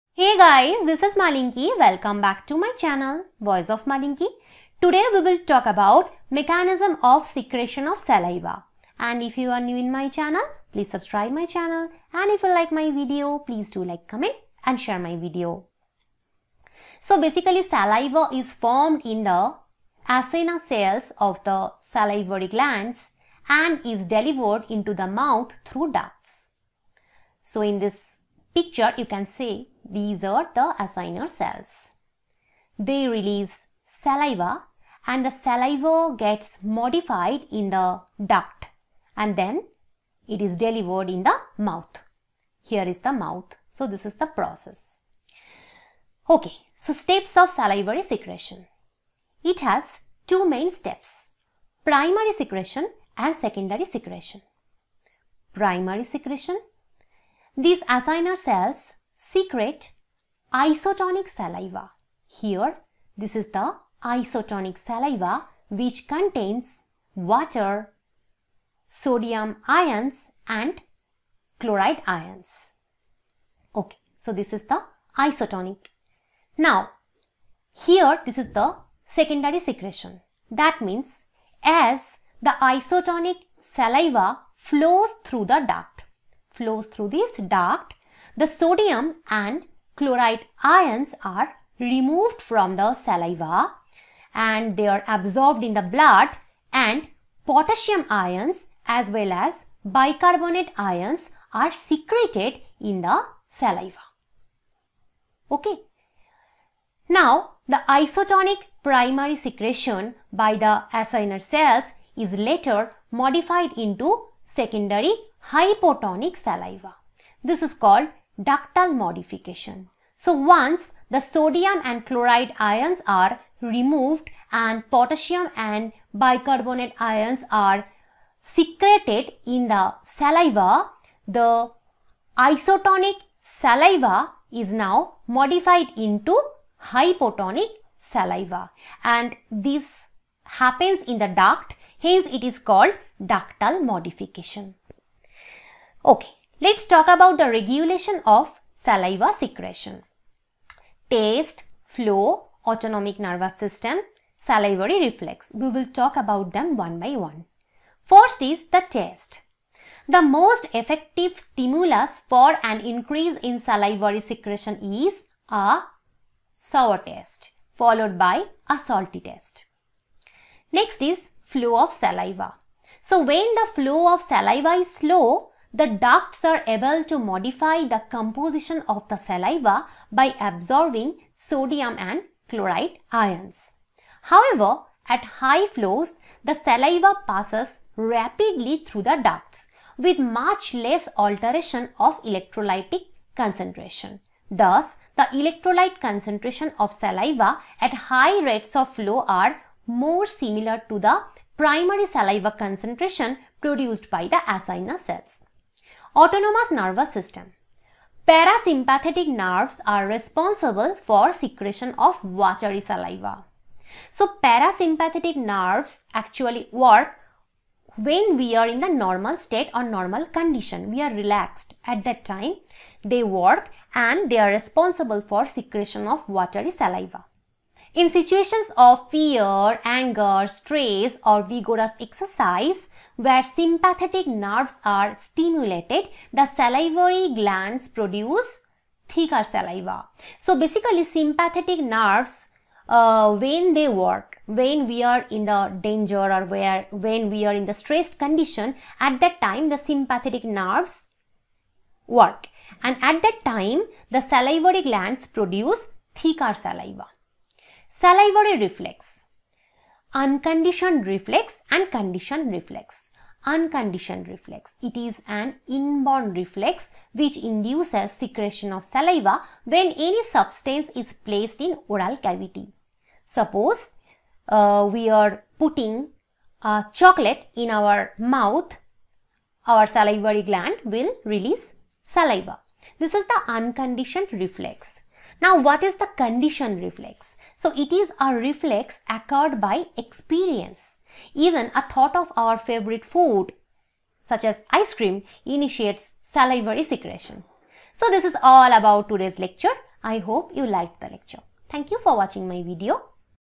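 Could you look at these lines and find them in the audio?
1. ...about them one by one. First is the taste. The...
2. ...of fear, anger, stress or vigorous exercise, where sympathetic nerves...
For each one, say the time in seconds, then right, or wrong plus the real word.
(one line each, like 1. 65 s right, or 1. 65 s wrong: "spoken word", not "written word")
1. 156 s right
2. 228 s right.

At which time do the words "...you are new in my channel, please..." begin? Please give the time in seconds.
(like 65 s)
9 s.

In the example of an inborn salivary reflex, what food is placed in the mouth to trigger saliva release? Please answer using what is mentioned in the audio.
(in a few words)
Chocolate.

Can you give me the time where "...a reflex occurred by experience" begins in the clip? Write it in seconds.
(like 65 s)
288 s.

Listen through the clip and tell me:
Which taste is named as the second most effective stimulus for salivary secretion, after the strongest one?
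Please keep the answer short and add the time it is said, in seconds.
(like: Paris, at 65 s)
Salty, at 168 s.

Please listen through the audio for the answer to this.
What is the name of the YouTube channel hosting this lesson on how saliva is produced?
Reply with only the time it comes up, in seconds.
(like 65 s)
3 s.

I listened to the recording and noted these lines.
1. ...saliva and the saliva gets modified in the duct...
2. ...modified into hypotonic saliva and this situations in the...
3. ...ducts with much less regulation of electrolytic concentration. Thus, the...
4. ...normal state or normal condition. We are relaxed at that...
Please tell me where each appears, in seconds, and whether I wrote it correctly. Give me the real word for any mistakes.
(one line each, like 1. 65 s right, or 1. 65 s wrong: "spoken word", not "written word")
1. 33 s right
2. 135 s wrong: "happens", not "situations"
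3. 189 s wrong: "alteration", not "regulation"
4. 219 s right.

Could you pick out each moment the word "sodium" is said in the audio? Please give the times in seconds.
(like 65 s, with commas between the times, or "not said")
68 s, 88 s, 121 s, 181 s.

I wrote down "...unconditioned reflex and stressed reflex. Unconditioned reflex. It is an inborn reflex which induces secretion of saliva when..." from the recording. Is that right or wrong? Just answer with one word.
wrong.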